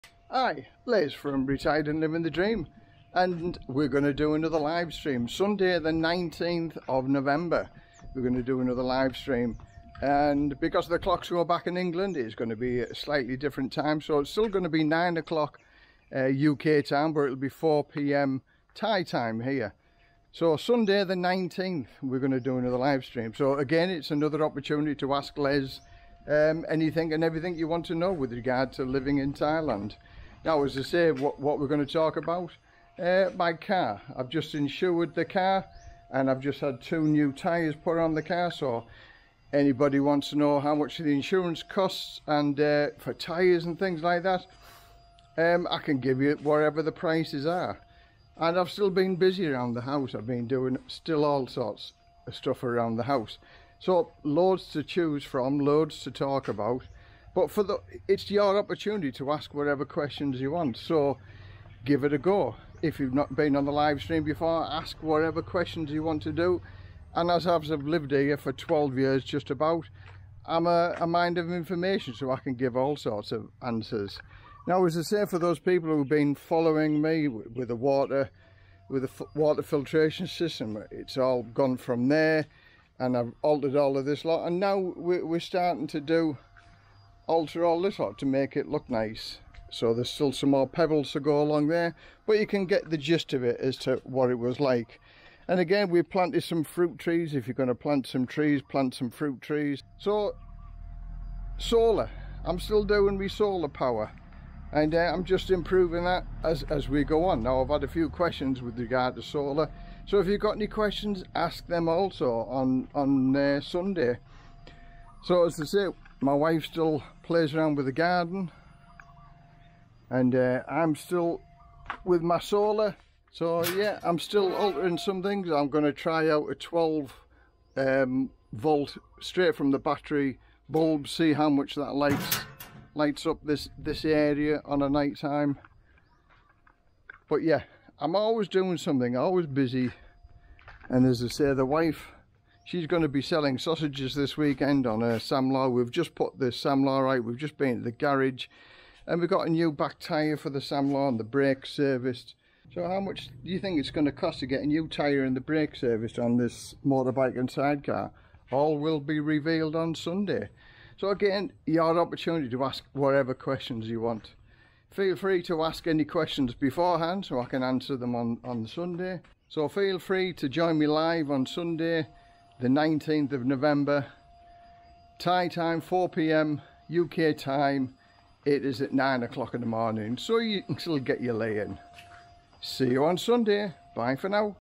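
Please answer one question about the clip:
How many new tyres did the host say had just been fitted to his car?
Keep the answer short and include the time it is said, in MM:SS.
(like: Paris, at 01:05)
2, at 00:36.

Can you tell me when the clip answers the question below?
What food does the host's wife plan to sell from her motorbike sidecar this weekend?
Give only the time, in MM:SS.
02:23.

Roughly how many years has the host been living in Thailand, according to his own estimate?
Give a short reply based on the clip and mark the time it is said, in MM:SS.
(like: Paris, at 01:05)
12, at 01:08.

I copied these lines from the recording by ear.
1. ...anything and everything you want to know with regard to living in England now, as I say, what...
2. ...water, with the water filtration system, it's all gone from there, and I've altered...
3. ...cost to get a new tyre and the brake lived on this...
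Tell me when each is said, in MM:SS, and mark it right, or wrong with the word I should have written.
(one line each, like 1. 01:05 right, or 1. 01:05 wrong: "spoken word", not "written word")
1. 00:26 wrong: "Thailand", not "England"
2. 01:17 right
3. 02:34 wrong: "serviced", not "lived".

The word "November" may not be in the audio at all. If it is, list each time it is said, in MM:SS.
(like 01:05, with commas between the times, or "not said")
00:07, 02:53.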